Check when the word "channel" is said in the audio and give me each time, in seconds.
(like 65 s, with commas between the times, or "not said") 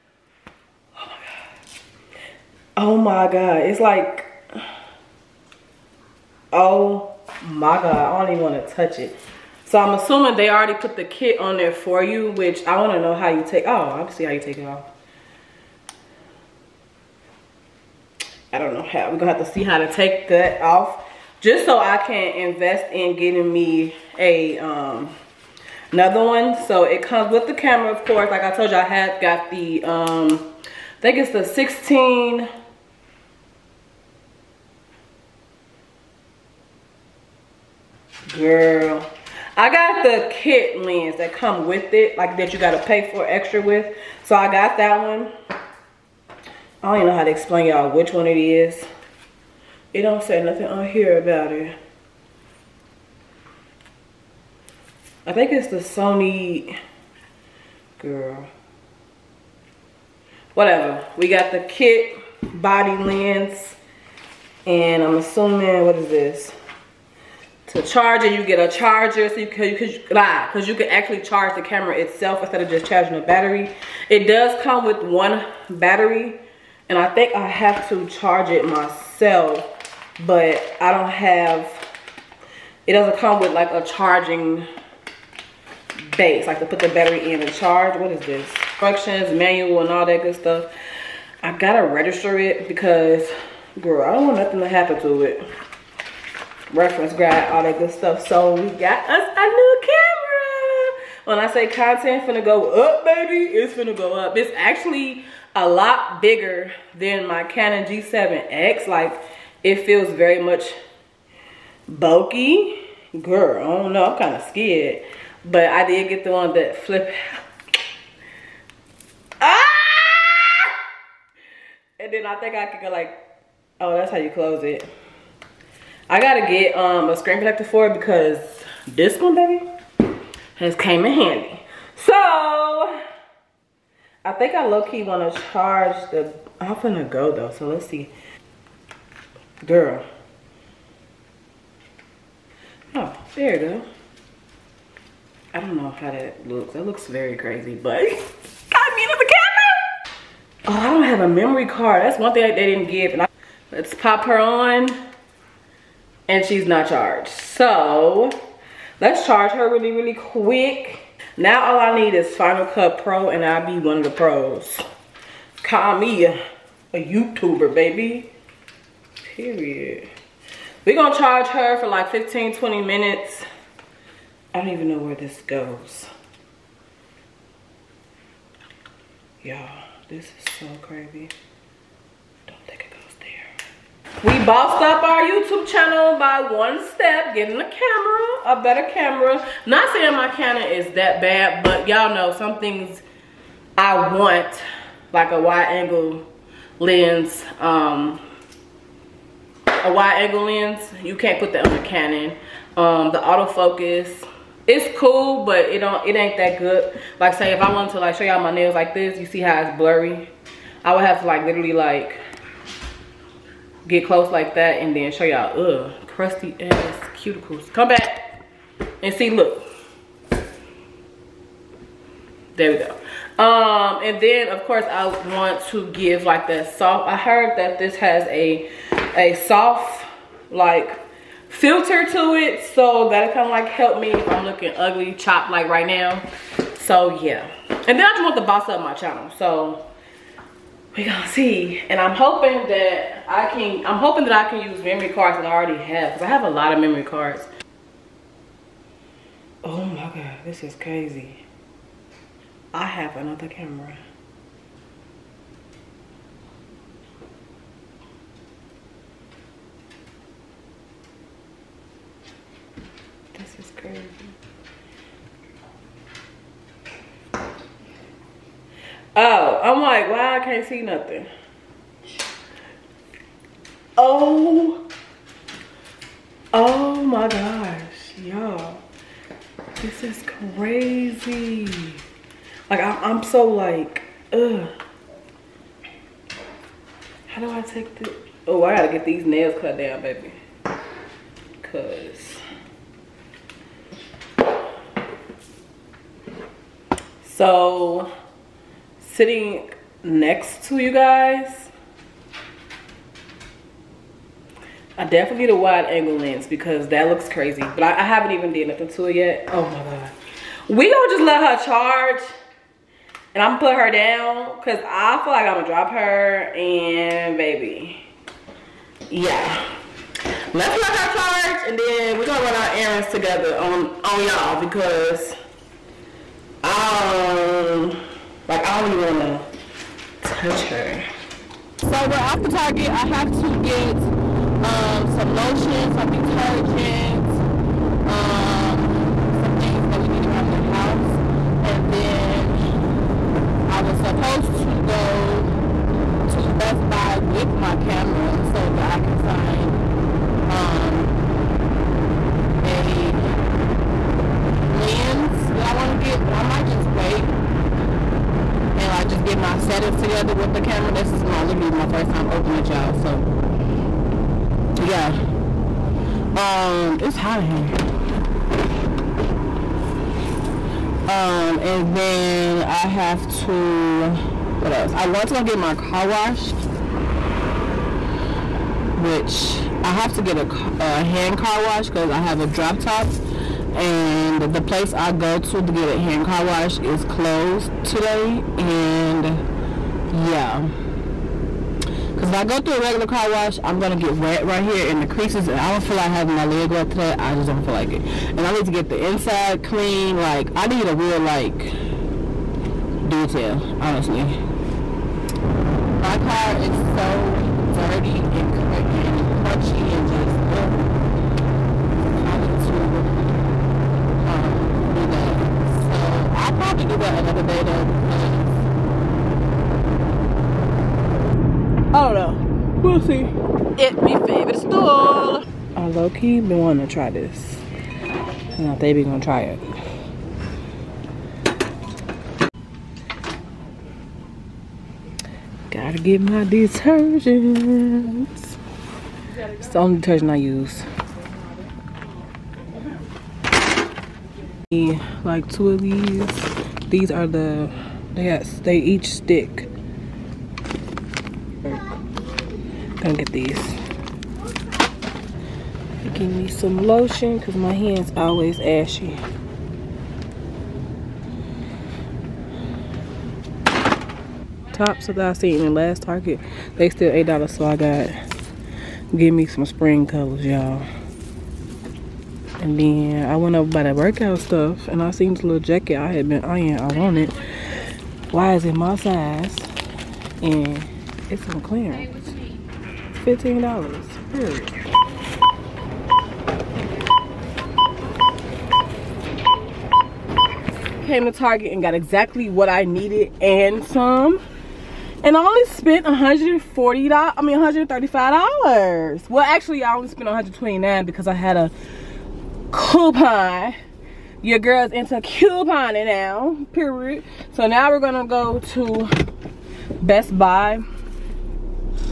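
185 s, 238 s.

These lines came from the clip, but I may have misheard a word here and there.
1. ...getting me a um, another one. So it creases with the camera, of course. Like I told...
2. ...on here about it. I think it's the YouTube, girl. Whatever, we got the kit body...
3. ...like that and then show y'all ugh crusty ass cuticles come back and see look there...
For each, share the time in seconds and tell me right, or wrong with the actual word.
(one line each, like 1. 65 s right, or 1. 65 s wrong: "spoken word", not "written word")
1. 23 s wrong: "comes", not "creases"
2. 50 s wrong: "Sony", not "YouTube"
3. 214 s right.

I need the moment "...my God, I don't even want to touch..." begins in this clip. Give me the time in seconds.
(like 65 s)
7 s.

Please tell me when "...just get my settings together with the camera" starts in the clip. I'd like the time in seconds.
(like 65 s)
359 s.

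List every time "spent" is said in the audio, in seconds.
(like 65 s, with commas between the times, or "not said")
495 s, 500 s.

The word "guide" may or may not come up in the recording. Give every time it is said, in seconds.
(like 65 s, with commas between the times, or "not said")
97 s.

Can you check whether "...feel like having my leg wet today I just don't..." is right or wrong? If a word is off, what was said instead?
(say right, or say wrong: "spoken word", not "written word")
right.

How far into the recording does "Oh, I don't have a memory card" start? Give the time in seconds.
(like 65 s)
150 s.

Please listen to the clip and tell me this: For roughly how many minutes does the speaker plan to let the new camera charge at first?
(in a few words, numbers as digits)
15-20 minutes.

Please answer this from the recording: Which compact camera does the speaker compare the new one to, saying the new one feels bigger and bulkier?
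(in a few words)
Canon G7X.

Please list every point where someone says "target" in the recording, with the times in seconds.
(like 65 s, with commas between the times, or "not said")
332 s, 466 s, 491 s.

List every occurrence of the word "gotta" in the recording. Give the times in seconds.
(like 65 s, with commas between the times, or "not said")
91 s, 126 s, 288 s, 435 s.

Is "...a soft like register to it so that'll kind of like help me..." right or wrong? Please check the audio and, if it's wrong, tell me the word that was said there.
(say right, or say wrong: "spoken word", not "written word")
wrong: "filter", not "register".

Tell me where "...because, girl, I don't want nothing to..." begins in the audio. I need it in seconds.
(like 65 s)
92 s.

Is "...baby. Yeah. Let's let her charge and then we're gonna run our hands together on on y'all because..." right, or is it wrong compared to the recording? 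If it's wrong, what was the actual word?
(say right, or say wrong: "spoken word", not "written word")
wrong: "errands", not "hands".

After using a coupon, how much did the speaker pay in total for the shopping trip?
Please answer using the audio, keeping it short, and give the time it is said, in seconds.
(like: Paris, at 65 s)
129, at 500 s.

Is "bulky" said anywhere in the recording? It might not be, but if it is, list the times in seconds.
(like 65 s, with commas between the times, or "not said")
111 s.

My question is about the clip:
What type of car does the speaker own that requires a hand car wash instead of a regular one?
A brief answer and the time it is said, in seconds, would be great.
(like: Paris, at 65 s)
drop top, at 382 s.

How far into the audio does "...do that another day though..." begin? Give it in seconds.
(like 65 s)
416 s.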